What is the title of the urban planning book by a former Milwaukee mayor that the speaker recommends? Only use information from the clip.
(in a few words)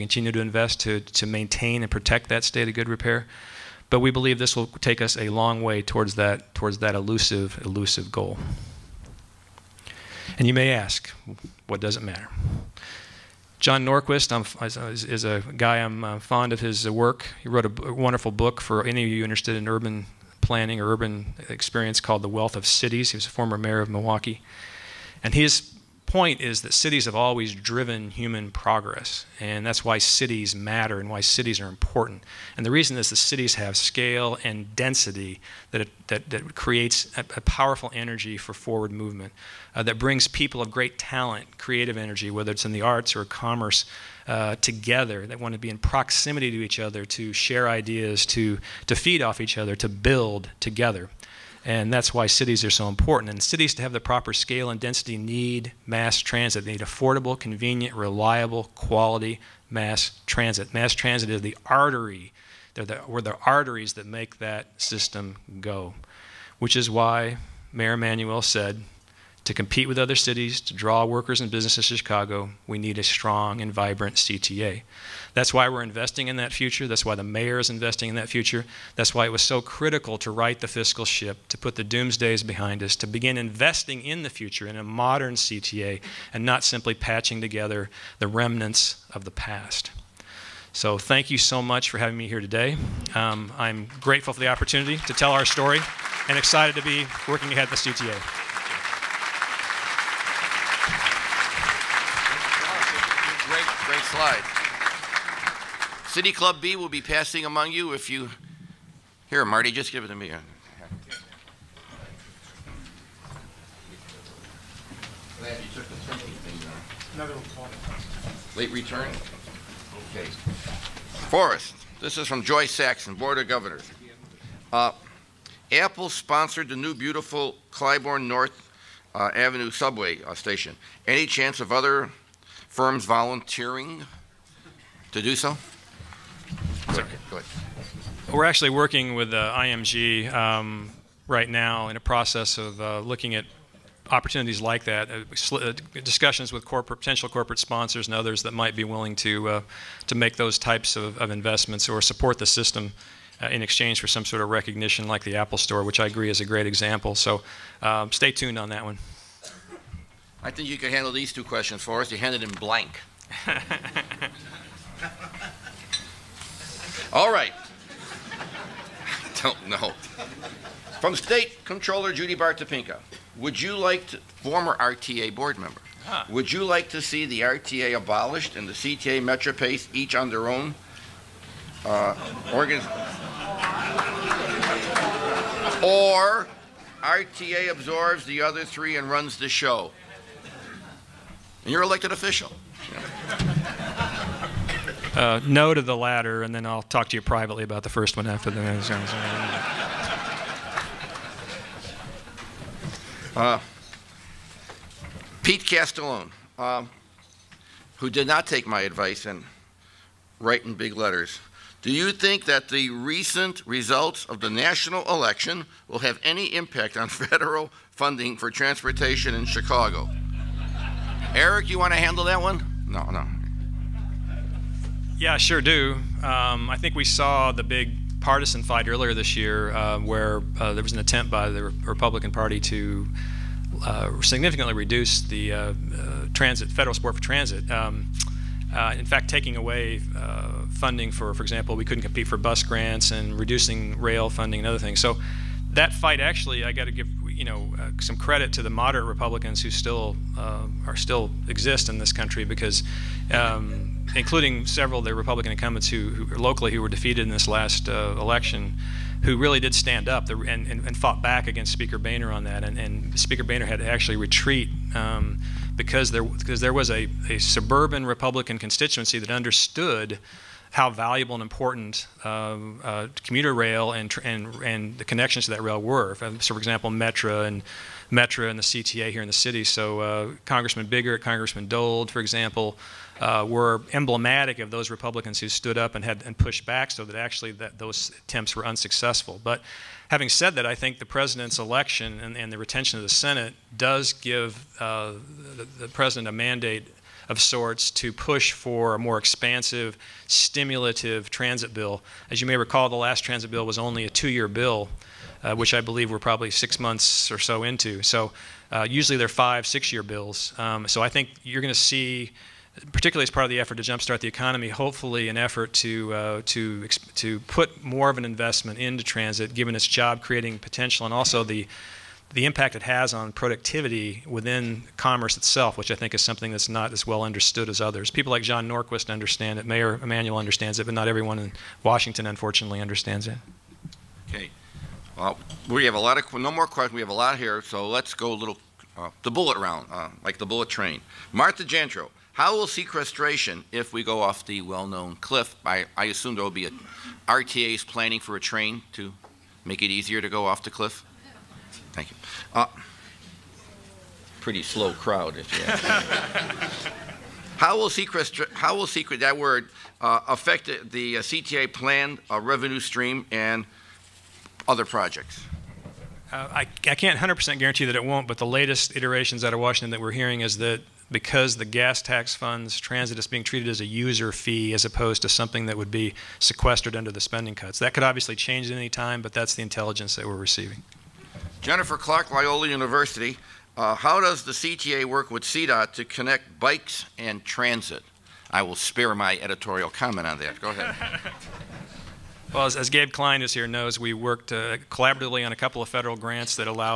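The Wealth of Cities.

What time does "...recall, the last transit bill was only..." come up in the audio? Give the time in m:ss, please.
5:02.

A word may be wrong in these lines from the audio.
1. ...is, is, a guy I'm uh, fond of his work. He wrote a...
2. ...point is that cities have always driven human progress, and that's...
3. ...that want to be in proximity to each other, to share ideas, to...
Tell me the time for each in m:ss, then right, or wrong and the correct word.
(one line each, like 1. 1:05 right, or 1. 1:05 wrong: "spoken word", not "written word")
1. 0:14 right
2. 0:26 right
3. 0:45 right.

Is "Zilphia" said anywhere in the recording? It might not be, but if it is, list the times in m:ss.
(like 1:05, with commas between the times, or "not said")
not said.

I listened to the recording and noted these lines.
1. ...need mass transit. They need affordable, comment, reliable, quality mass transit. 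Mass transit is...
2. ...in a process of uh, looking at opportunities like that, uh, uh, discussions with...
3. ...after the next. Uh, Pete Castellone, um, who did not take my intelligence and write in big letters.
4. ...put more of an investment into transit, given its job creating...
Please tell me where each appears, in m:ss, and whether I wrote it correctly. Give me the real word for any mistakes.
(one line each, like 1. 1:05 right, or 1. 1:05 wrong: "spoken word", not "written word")
1. 0:55 wrong: "convenient", not "comment"
2. 2:21 right
3. 3:18 wrong: "advice", not "intelligence"
4. 5:17 right.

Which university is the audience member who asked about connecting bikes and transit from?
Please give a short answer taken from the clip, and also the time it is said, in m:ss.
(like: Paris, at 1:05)
Loyola University, at 6:22.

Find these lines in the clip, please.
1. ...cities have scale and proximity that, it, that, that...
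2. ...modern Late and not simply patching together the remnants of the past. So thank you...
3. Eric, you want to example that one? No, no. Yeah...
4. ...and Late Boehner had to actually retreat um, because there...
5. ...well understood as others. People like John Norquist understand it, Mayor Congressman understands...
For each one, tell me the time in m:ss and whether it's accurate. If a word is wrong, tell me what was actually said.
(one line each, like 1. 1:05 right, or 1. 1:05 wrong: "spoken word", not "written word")
1. 0:33 wrong: "density", not "proximity"
2. 1:24 wrong: "CTA", not "Late"
3. 3:41 wrong: "handle", not "example"
4. 4:22 wrong: "Speaker", not "Late"
5. 5:27 wrong: "Emanuel", not "Congressman".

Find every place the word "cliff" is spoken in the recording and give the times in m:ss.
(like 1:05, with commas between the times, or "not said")
5:45, 5:50.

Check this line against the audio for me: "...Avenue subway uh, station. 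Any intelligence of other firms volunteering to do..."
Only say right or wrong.
wrong.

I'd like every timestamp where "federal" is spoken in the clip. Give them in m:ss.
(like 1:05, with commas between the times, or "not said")
3:37, 3:56, 6:35.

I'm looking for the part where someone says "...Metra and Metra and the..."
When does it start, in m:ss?
4:36.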